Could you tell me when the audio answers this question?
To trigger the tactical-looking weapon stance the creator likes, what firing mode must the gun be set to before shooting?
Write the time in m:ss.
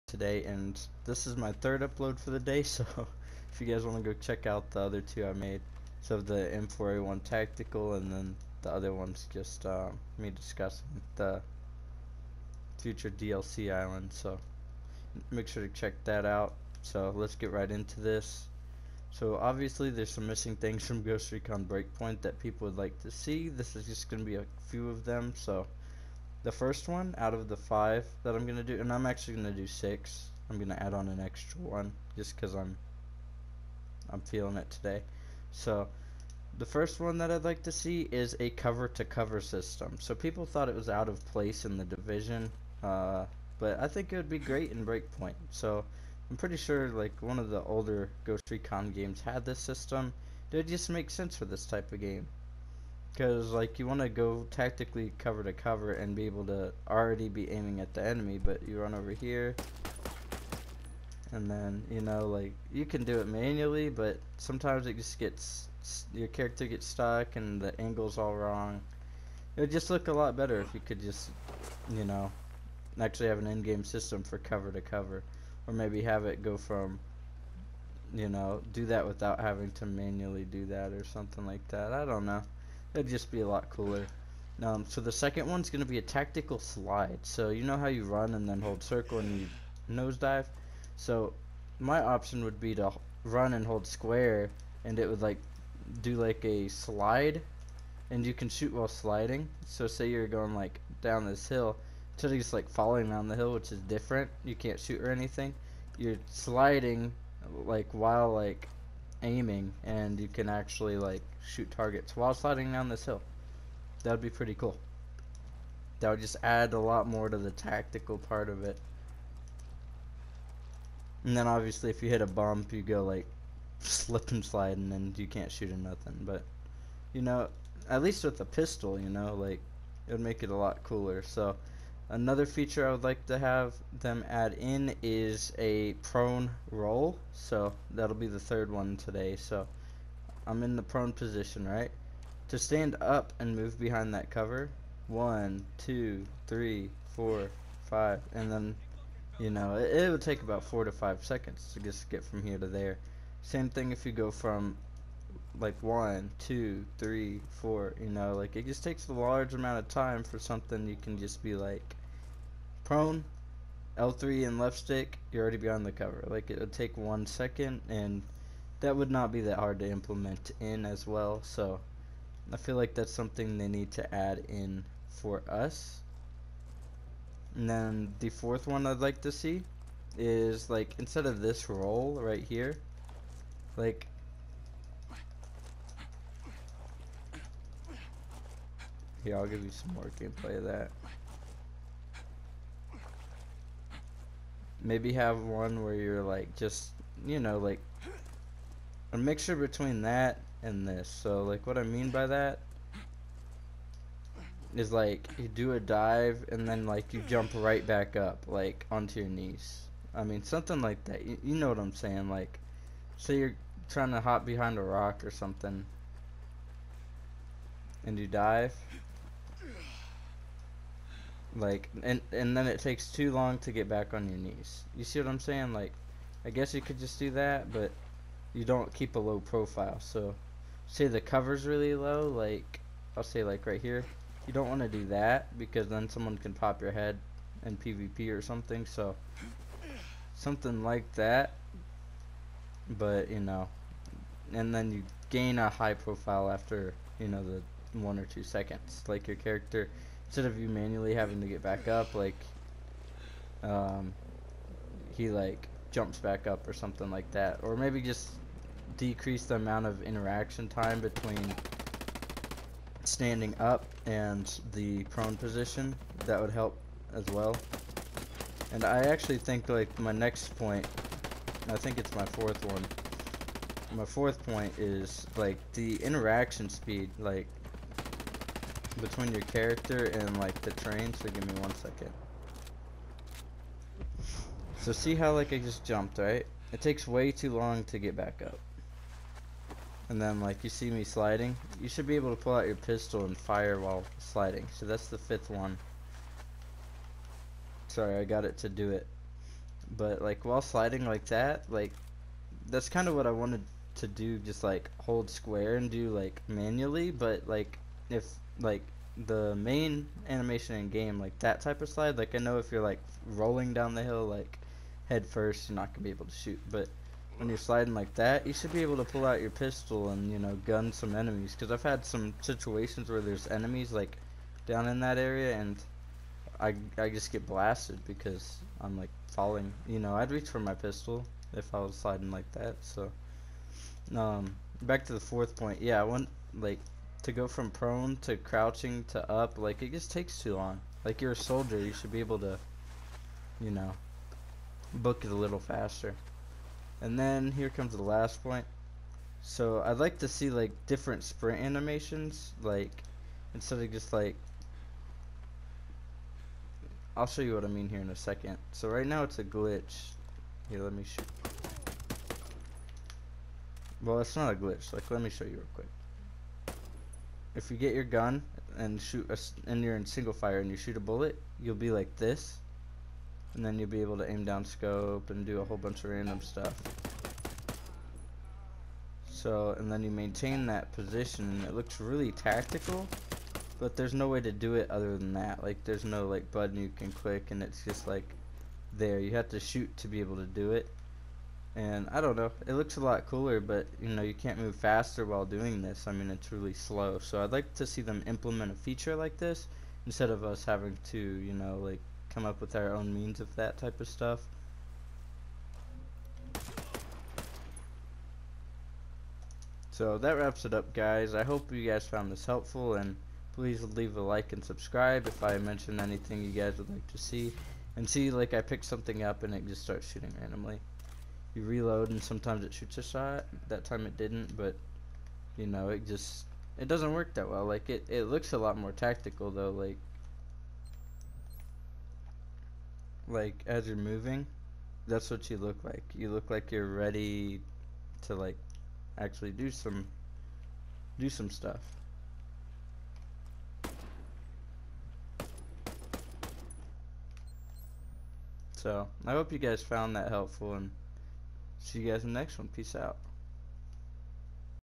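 6:10.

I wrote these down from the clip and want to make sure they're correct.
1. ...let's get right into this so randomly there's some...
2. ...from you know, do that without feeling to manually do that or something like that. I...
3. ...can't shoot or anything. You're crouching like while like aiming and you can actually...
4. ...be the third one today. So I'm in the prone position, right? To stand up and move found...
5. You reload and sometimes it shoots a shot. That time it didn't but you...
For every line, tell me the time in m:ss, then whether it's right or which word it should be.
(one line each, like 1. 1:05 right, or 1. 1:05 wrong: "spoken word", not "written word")
1. 0:17 wrong: "obviously", not "randomly"
2. 1:16 wrong: "having", not "feeling"
3. 1:44 wrong: "sliding", not "crouching"
4. 2:18 wrong: "behind", not "found"
5. 7:01 right.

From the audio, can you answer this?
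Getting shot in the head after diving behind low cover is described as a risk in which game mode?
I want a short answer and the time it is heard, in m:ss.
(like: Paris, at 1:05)
PvP, at 3:57.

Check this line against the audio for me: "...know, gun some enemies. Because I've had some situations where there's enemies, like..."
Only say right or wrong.
right.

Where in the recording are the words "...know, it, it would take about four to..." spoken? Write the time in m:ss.
2:29.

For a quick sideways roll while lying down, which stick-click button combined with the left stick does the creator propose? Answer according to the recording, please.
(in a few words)
L3.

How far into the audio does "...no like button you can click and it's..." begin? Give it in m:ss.
6:26.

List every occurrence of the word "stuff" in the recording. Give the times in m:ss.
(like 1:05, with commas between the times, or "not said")
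6:16, 6:44, 7:21.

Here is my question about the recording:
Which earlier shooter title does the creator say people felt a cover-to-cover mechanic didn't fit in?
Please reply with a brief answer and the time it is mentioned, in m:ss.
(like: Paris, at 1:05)
The Division, at 0:41.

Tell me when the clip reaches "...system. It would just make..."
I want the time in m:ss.
0:49.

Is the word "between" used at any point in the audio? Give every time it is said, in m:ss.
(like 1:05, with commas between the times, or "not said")
3:19, 4:21, 4:39.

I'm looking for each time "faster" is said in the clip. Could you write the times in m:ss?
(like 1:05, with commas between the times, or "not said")
5:45, 6:34.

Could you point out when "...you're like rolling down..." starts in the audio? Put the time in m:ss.
5:12.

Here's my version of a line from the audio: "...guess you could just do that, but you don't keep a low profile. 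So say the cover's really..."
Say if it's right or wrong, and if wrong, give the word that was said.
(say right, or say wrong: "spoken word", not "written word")
right.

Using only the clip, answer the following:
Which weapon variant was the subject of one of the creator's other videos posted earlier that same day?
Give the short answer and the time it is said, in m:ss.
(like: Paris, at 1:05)
M4A1 tactical, at 0:06.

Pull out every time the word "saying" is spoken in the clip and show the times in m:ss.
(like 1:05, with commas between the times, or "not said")
3:31, 3:45.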